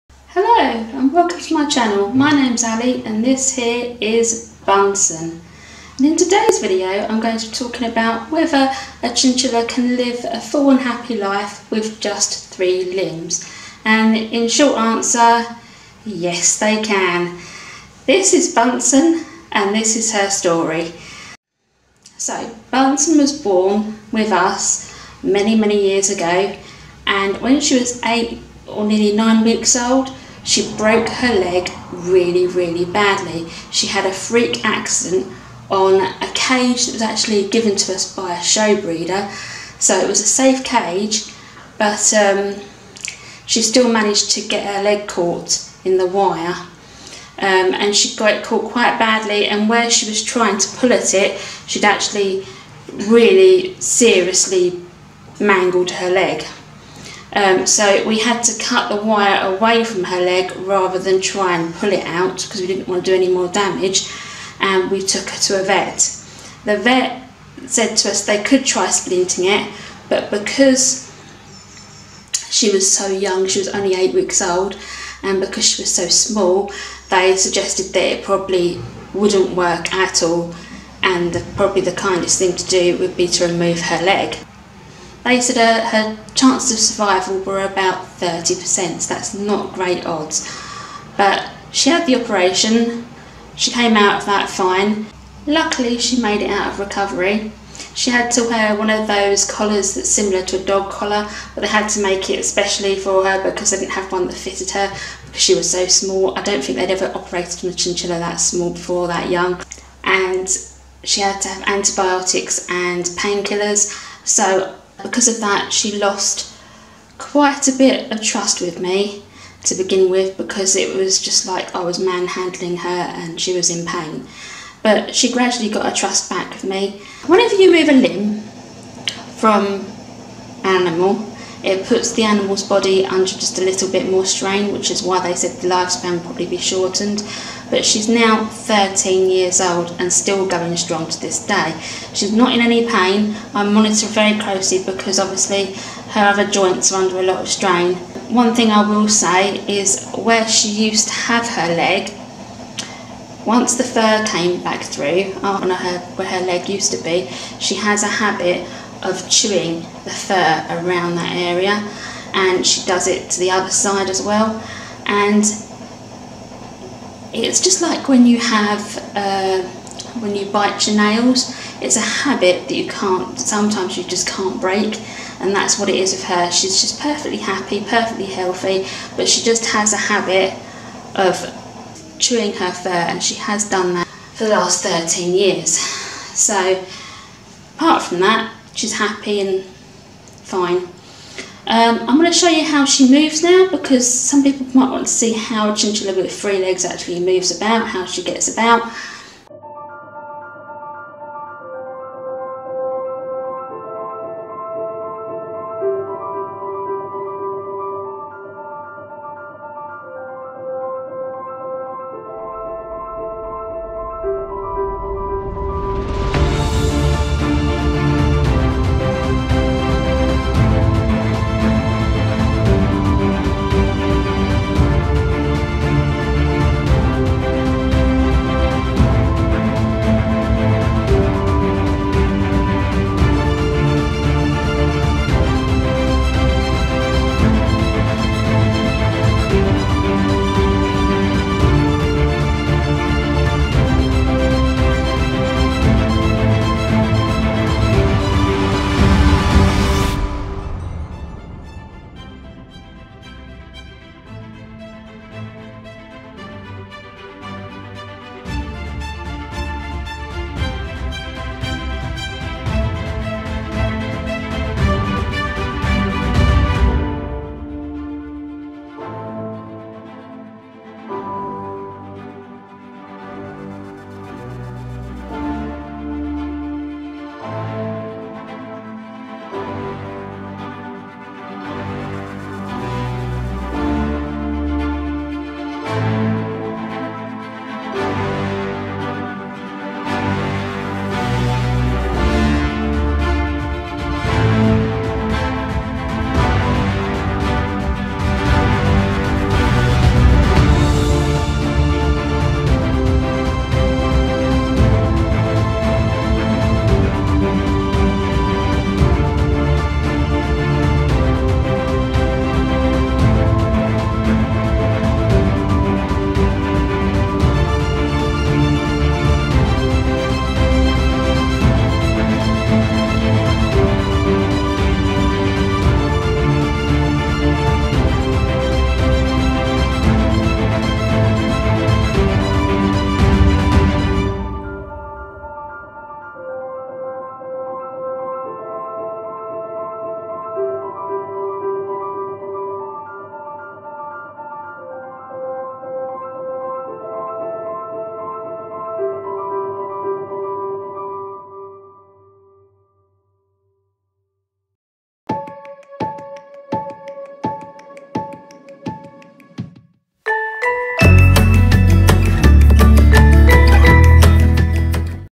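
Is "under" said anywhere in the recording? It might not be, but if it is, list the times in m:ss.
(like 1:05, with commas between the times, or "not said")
2:13, 2:27.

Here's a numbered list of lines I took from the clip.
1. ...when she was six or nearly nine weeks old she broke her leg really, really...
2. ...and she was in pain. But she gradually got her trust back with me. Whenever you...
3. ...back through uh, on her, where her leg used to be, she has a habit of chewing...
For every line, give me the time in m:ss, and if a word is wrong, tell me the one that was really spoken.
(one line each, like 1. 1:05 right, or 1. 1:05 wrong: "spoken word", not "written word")
1. 0:27 wrong: "eight", not "six"
2. 2:02 right
3. 2:34 right.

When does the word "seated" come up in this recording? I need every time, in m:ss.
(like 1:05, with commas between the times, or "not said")
not said.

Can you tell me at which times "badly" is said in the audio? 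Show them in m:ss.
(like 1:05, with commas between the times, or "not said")
0:32, 0:48.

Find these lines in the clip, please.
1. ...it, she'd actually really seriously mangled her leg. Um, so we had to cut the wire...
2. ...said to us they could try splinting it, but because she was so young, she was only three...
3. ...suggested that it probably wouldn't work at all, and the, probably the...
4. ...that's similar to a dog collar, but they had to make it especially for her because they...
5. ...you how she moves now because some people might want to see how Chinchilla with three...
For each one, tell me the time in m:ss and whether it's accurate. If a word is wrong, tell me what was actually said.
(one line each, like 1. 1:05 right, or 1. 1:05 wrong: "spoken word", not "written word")
1. 0:51 right
2. 1:07 wrong: "eight", not "three"
3. 1:17 right
4. 1:39 right
5. 3:12 right.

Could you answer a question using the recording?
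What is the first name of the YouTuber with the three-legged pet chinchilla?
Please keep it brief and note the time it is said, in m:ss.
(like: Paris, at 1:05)
Ally, at 0:02.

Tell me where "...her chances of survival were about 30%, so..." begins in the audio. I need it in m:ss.
1:25.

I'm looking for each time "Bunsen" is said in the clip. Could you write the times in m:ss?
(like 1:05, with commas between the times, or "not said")
0:04, 0:18, 0:22.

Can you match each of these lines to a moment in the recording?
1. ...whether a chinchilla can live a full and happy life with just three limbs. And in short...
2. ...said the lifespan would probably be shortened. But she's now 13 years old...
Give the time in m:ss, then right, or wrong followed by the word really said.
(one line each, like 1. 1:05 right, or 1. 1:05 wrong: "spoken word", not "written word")
1. 0:08 right
2. 2:15 right.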